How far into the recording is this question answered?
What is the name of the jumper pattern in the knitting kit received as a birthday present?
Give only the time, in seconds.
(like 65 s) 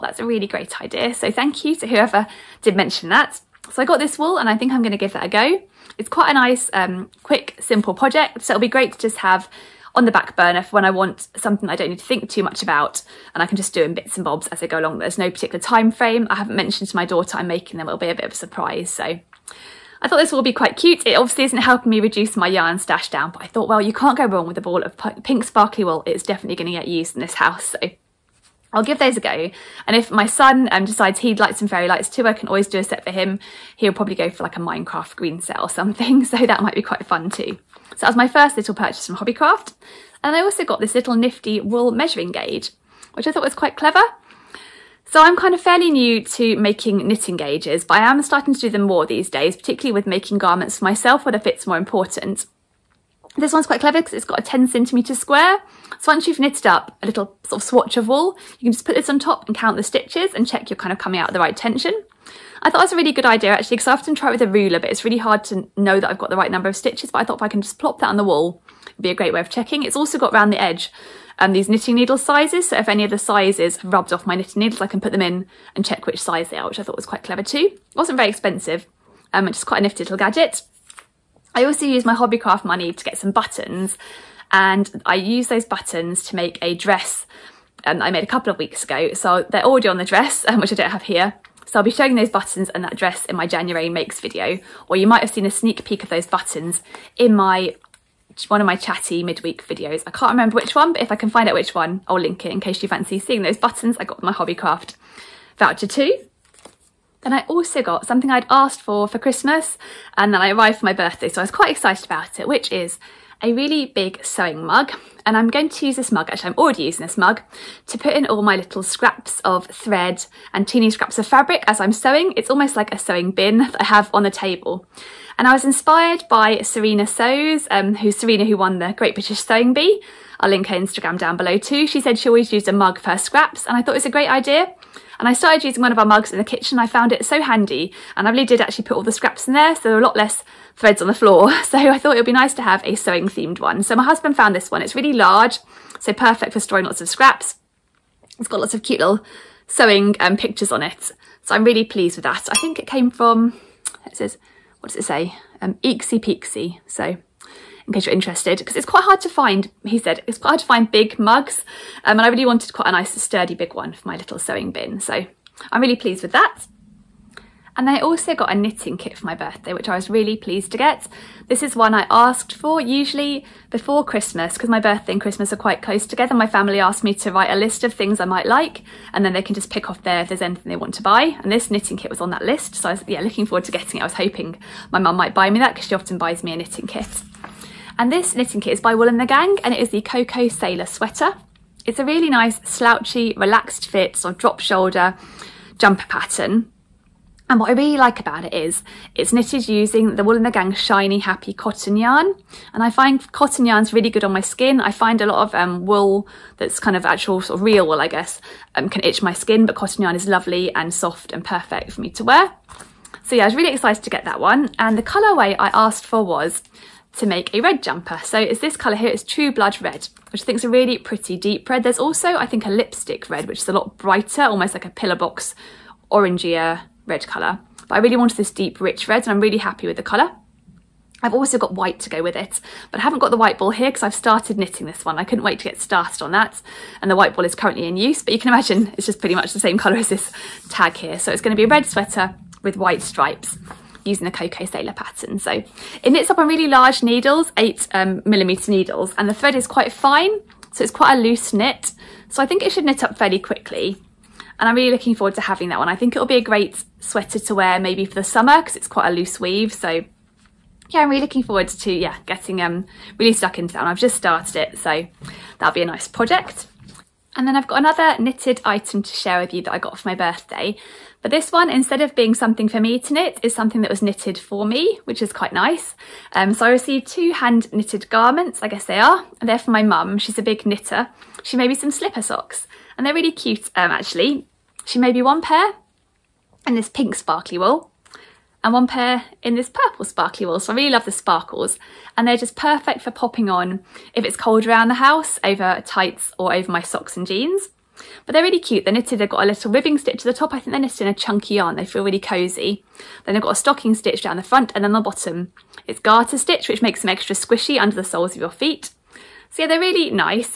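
190 s.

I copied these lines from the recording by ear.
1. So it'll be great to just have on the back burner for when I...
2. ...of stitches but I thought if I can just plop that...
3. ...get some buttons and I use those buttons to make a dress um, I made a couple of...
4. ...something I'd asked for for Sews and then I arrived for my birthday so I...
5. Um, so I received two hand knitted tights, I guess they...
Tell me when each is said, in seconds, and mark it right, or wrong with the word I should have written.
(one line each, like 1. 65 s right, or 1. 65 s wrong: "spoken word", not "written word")
1. 8 s right
2. 66 s right
3. 83 s right
4. 108 s wrong: "Christmas", not "Sews"
5. 276 s wrong: "garments", not "tights".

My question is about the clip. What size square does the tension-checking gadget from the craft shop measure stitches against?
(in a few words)
10 centimeters.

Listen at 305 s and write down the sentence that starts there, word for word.
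It's garter stitch, which makes them extra squishy under the soles of your feet.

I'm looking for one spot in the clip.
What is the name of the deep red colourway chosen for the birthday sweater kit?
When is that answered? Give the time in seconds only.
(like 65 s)
219 s.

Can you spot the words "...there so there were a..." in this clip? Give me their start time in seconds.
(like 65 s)
139 s.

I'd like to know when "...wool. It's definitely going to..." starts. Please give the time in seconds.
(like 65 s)
25 s.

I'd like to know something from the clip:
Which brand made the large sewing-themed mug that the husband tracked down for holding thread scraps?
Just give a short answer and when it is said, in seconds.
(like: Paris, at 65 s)
Eeksie Peeksie, at 155 s.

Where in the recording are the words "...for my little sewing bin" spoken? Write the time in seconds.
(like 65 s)
163 s.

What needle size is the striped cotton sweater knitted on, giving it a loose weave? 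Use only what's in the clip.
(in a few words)
8 millimeters.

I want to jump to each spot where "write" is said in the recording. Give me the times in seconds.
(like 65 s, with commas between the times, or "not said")
177 s.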